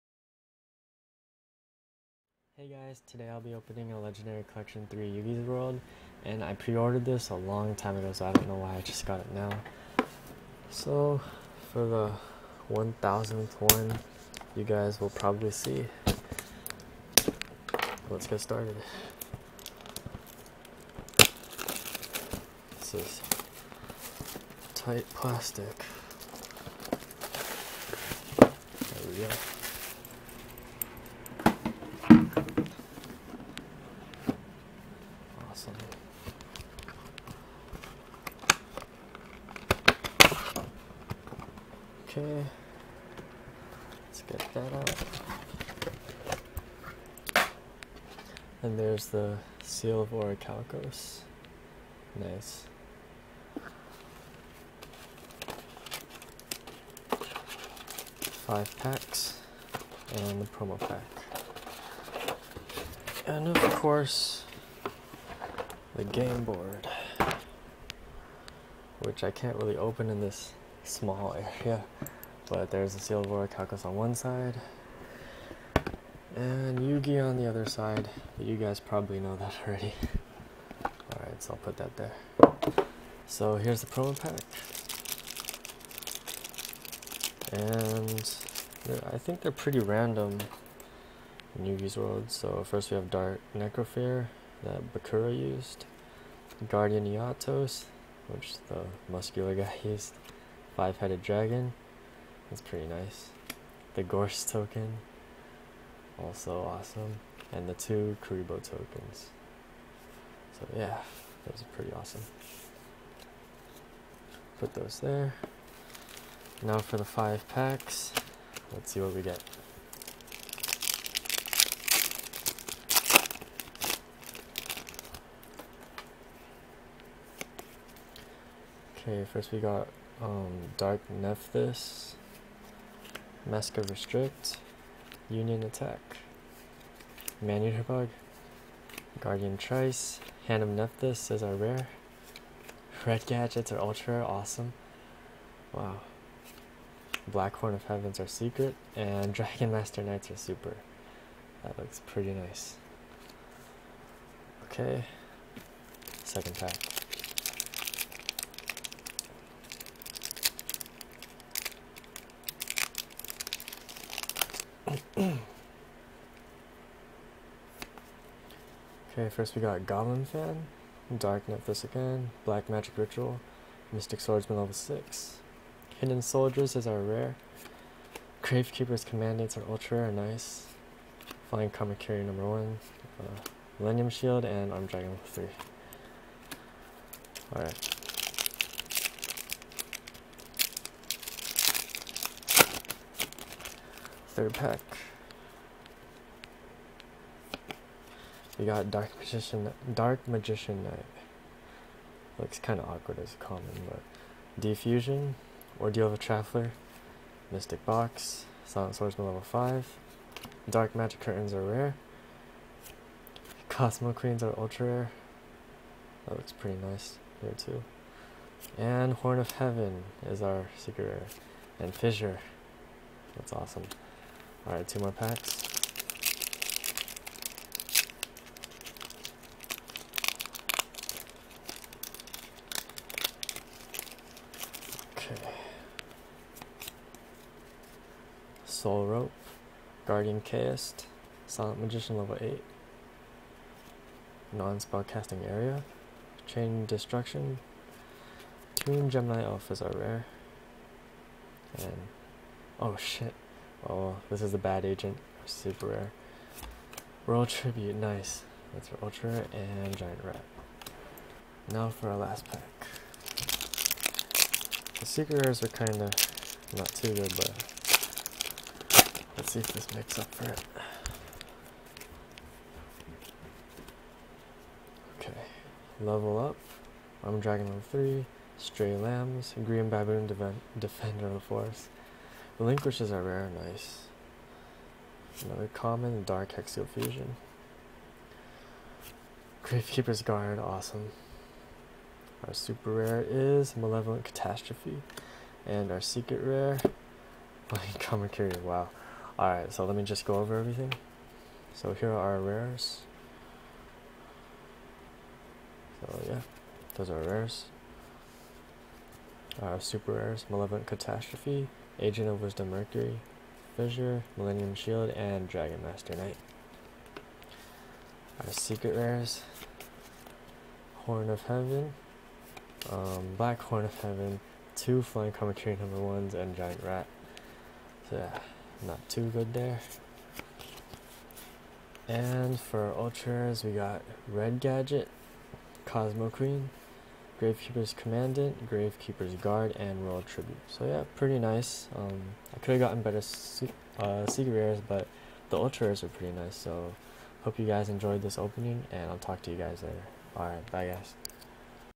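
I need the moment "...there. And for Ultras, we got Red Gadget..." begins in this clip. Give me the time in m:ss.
5:29.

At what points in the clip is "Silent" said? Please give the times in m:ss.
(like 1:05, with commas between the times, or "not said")
3:28, 4:01.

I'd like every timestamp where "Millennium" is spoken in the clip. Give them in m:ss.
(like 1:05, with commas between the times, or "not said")
3:03, 5:14.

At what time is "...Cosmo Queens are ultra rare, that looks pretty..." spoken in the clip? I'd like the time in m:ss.
3:33.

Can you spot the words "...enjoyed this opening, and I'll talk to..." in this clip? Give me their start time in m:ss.
5:47.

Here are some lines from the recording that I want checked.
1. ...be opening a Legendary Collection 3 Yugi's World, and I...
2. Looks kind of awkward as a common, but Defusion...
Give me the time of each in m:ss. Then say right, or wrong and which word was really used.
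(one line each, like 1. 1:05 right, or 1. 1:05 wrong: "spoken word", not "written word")
1. 0:03 right
2. 3:22 right.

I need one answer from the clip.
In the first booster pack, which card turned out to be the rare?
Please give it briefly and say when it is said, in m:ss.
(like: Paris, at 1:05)
Hand of Nephthys, at 2:20.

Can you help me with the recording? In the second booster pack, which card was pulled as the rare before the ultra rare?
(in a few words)
Hidden Soldiers.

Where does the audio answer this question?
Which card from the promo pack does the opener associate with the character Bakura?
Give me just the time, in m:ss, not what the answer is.
1:33.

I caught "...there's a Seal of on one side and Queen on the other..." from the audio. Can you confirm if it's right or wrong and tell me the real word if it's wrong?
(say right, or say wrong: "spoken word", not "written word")
wrong: "Yugi", not "Queen".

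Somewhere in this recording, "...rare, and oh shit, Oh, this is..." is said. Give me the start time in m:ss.
4:09.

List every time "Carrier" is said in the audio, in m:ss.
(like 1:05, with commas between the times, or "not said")
3:01, 4:58.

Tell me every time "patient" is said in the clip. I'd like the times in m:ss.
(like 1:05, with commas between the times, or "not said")
not said.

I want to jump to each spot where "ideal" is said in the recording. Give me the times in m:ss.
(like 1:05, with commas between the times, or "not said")
not said.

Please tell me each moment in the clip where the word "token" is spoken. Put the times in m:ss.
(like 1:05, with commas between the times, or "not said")
1:44, 1:48.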